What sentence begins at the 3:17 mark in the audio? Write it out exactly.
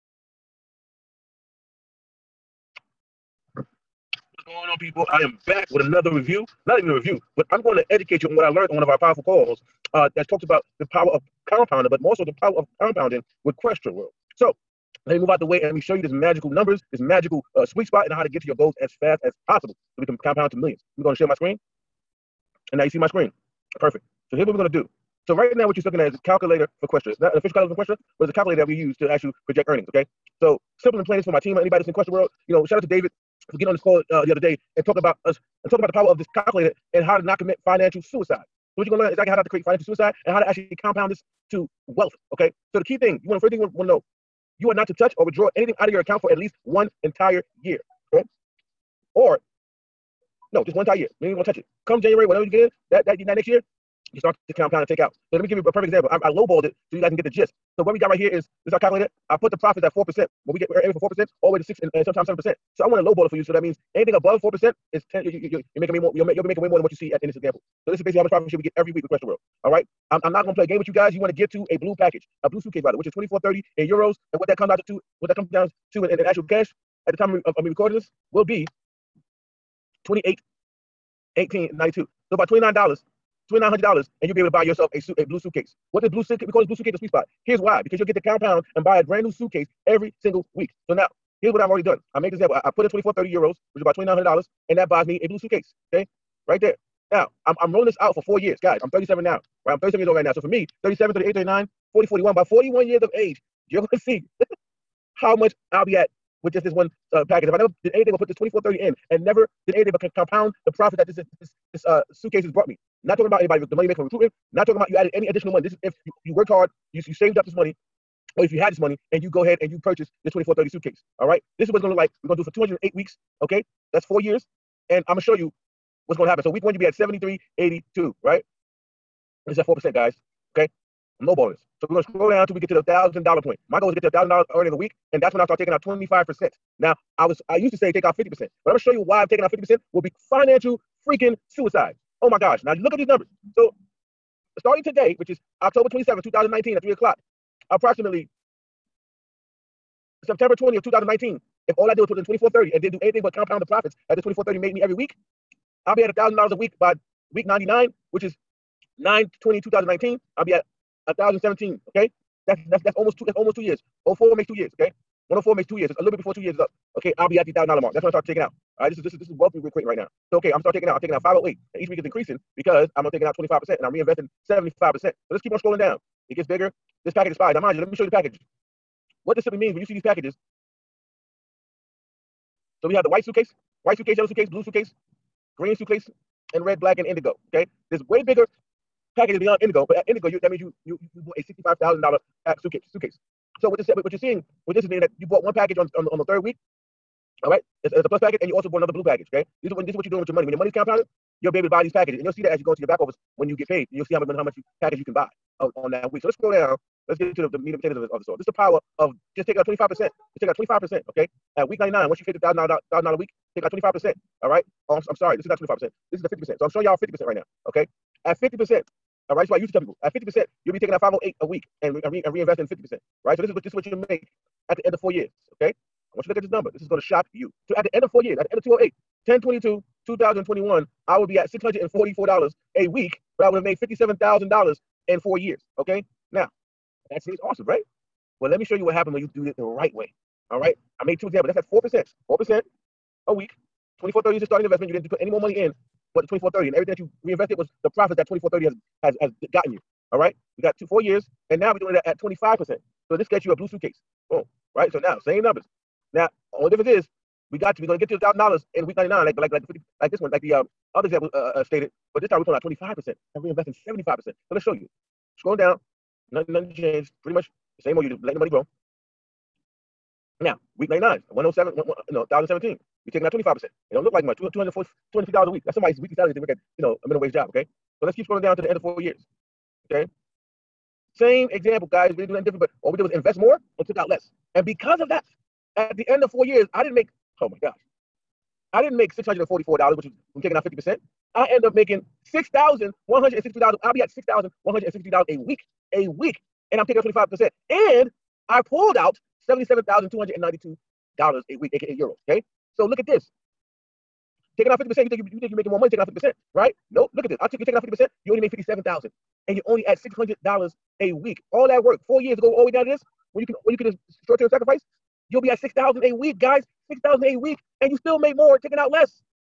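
All right, it's, it's a plus package, and you also bought another blue package.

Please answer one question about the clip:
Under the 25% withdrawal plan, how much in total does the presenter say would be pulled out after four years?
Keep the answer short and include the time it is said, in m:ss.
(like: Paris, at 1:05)
$77,292, at 4:59.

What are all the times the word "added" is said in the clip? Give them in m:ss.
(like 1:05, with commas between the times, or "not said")
1:54.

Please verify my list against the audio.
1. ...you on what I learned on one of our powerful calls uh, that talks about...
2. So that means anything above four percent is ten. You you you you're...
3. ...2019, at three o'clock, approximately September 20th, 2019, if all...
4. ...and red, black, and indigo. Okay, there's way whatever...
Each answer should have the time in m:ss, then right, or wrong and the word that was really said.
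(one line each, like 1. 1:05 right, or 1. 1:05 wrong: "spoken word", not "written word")
1. 0:08 right
2. 1:03 right
3. 2:26 right
4. 3:06 wrong: "bigger", not "whatever".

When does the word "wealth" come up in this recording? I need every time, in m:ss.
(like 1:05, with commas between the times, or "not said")
0:41, 2:49.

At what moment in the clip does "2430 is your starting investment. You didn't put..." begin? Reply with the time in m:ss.
4:03.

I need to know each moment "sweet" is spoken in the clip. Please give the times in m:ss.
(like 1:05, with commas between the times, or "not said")
0:17, 1:26.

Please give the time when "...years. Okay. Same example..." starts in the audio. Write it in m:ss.
4:38.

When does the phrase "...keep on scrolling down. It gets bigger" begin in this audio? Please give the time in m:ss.
2:55.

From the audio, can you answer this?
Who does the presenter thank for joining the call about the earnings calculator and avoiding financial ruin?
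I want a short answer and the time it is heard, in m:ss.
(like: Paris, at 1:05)
David, at 0:32.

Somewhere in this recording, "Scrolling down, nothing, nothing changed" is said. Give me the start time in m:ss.
4:25.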